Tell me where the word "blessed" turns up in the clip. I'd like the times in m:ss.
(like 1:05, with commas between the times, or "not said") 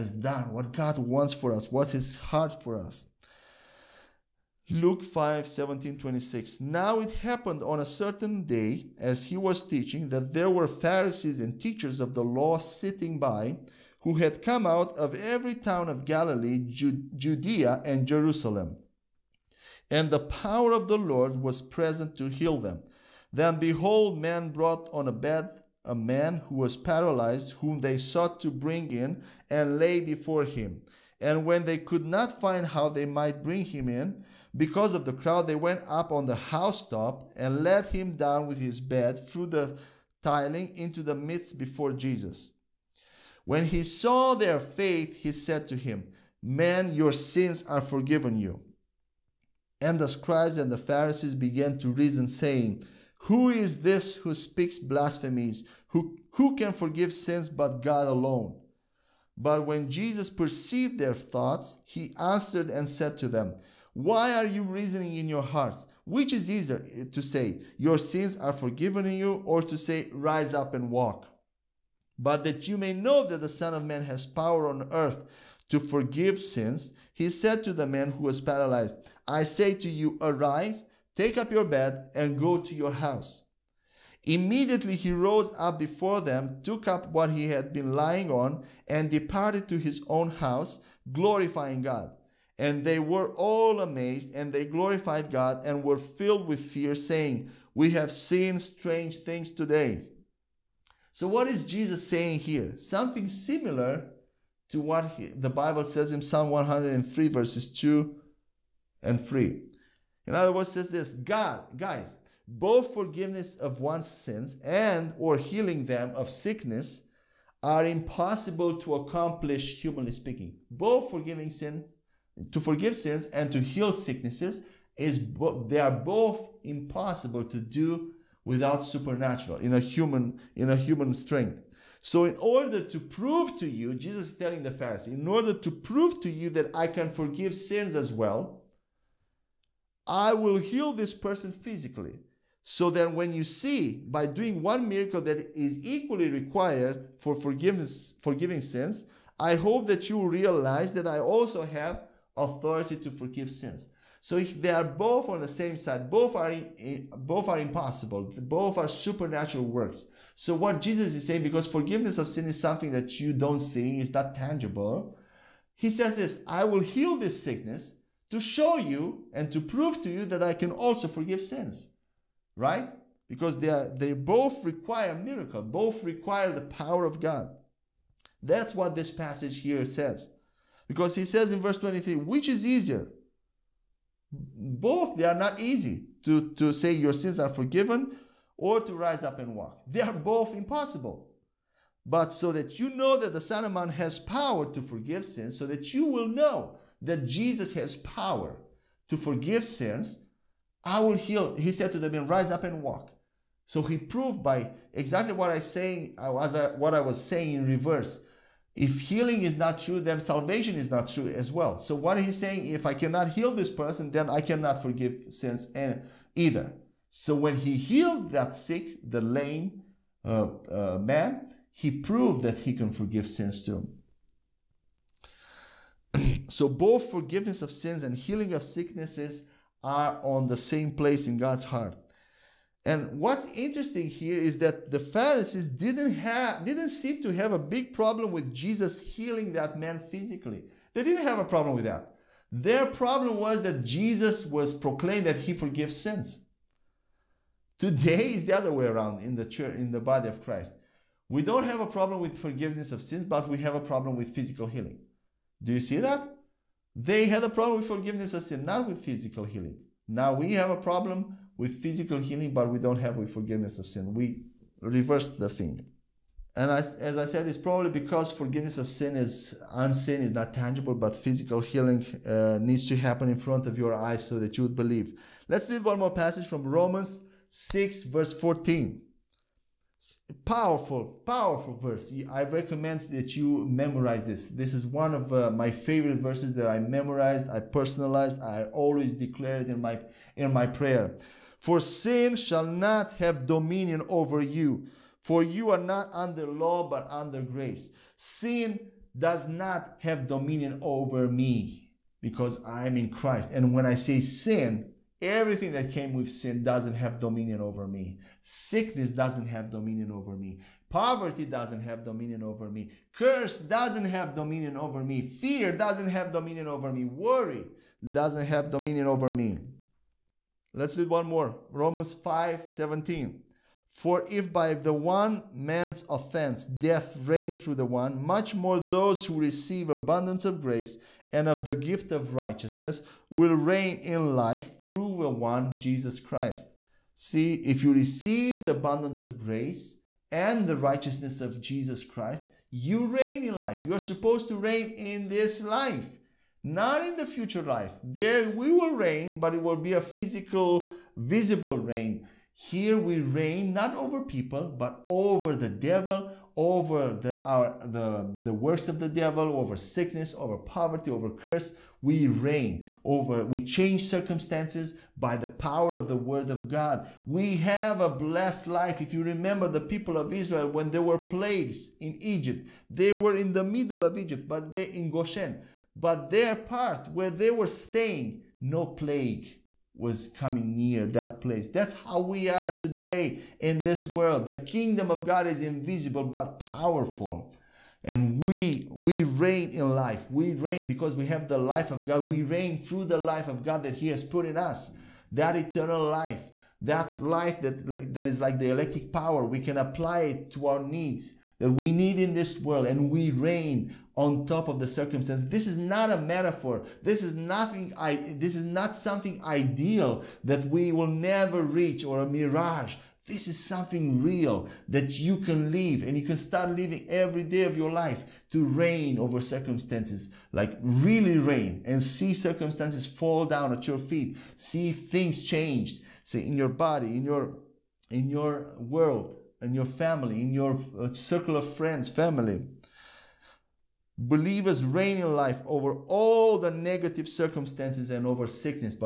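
6:08.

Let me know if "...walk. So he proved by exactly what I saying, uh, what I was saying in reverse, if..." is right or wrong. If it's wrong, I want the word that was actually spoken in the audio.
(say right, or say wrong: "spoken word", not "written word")
right.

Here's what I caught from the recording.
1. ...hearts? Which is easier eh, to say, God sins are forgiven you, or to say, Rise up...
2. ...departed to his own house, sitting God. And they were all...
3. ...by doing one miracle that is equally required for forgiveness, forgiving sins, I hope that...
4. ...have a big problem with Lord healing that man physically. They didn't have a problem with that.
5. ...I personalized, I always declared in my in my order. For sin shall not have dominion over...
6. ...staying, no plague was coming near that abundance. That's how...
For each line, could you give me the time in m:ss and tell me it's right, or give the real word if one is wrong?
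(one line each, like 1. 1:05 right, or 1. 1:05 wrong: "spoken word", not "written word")
1. 1:05 wrong: "Your", not "God"
2. 1:29 wrong: "glorifying", not "sitting"
3. 2:24 right
4. 3:57 wrong: "Jesus", not "Lord"
5. 4:47 wrong: "prayer", not "order"
6. 6:17 wrong: "place", not "abundance".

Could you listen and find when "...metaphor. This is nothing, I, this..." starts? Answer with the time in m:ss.
6:46.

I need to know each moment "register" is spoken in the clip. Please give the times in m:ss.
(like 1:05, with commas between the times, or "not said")
not said.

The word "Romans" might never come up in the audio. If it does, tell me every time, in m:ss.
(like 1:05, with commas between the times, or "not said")
4:36, 5:21.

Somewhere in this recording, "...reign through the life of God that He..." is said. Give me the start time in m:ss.
6:32.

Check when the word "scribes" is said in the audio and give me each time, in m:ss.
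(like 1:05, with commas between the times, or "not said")
0:50.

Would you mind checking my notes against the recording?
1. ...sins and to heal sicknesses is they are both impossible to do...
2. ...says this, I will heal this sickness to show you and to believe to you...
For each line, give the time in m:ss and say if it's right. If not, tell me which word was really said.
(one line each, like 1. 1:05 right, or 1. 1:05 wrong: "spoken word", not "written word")
1. 2:02 right
2. 2:45 wrong: "prove", not "believe".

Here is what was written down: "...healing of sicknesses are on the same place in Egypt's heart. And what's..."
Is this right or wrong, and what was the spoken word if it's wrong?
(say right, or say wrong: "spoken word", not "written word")
wrong: "God", not "Egypt".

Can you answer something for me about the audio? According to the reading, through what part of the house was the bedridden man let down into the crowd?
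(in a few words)
the tiling.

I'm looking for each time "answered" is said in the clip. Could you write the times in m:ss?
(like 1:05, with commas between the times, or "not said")
1:02.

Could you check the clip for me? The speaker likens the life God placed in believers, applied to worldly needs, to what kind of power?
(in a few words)
electric power.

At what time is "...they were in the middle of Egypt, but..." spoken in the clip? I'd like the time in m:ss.
6:12.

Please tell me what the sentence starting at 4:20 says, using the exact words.
Now we have a problem with physical healing, but we don't have with forgiveness of sin.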